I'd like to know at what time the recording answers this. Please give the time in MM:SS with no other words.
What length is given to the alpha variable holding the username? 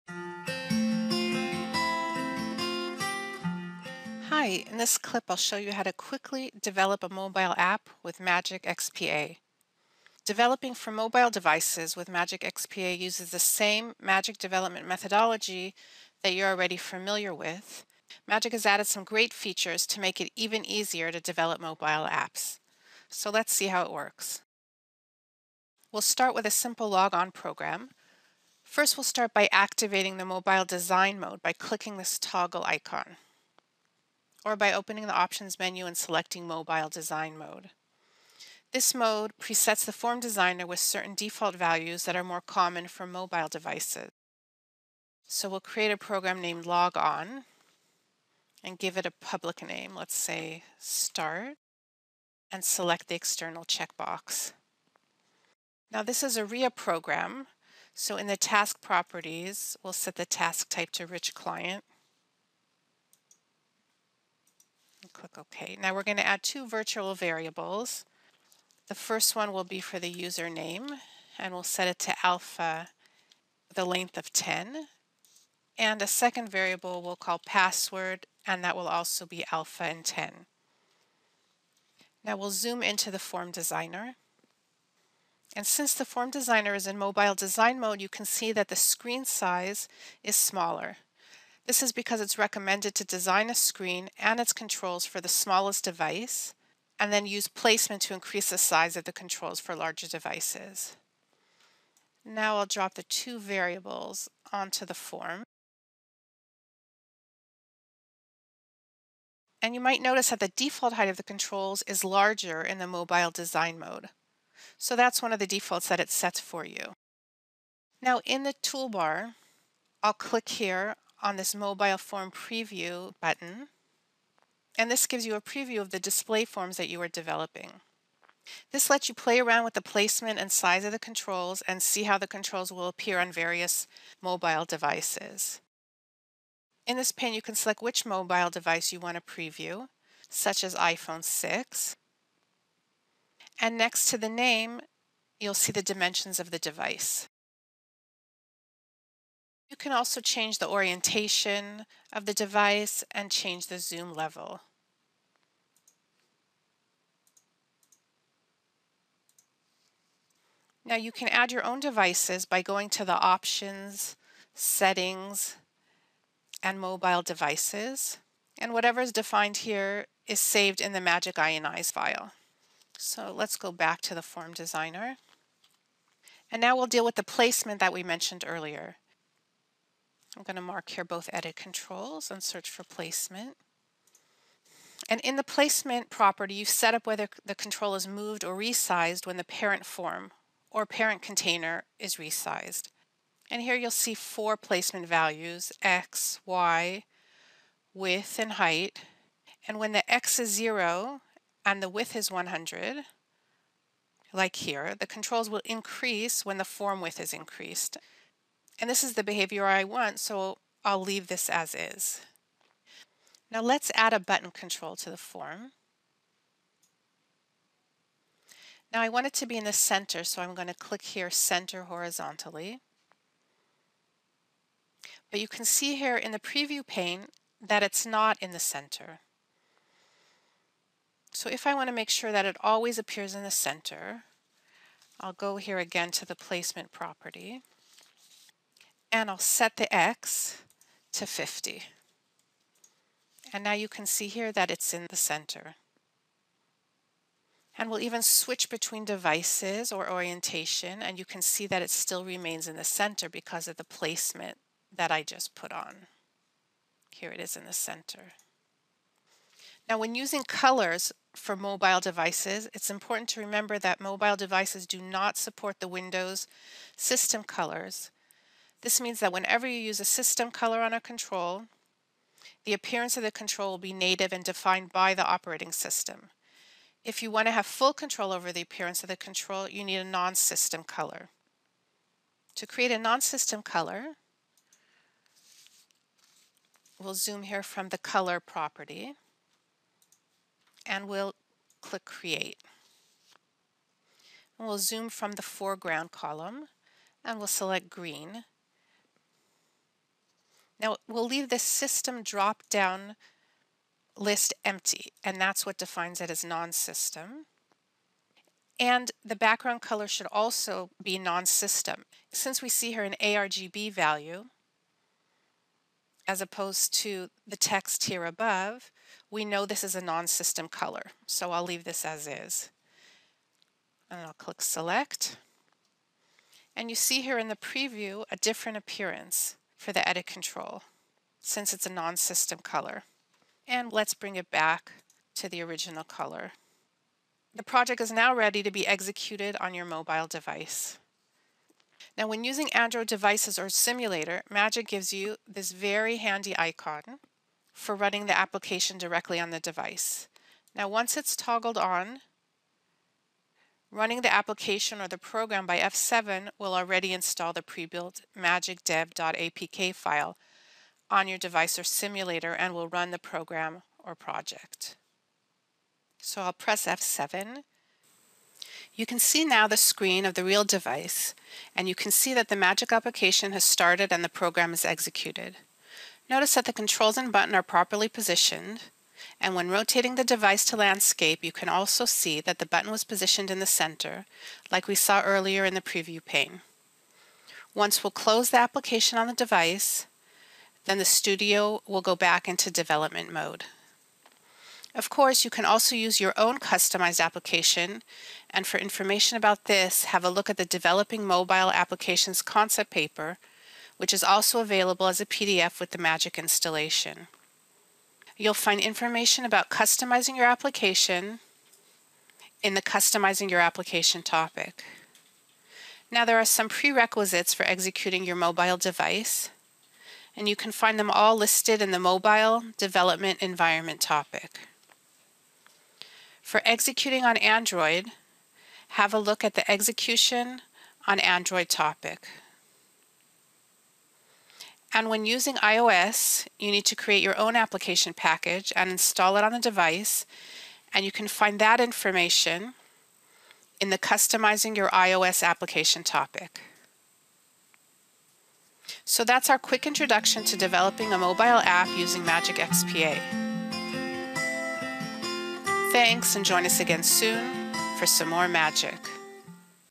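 01:12.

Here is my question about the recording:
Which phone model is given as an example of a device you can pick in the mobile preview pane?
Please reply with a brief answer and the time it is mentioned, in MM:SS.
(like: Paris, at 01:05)
iPhone 6, at 02:20.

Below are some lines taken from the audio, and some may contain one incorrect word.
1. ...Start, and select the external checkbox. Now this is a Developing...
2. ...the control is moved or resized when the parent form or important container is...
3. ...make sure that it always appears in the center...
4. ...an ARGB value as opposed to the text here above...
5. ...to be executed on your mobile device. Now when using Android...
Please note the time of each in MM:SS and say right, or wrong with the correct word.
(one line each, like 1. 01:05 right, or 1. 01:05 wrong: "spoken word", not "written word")
1. 00:50 wrong: "RIA", not "Developing"
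2. 03:07 wrong: "parent", not "important"
3. 03:51 right
4. 05:13 right
5. 05:38 right.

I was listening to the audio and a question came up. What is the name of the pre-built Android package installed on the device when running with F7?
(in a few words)
magicdev.apk.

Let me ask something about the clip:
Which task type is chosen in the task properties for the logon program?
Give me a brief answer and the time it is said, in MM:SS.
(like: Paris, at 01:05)
rich client, at 01:01.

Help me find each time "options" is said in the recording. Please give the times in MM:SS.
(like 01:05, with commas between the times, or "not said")
00:35, 02:43.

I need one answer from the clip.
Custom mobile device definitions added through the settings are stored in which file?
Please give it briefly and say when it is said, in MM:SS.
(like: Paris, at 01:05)
Magic INI file, at 02:50.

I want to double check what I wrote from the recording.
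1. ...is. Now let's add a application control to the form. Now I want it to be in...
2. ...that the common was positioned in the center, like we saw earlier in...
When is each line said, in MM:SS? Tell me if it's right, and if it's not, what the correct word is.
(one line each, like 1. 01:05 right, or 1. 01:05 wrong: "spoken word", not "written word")
1. 03:31 wrong: "button", not "application"
2. 06:22 wrong: "button", not "common".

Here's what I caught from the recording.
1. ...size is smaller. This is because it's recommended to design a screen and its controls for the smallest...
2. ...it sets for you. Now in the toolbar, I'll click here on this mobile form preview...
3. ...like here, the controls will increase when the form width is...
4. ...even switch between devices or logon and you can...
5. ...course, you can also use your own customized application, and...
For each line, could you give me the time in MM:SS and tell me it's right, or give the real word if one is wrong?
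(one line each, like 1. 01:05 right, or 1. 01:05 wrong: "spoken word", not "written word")
1. 01:29 right
2. 01:56 right
3. 03:24 right
4. 04:07 wrong: "orientation", not "logon"
5. 06:35 right.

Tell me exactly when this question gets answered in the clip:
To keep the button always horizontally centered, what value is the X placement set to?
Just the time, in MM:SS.
04:01.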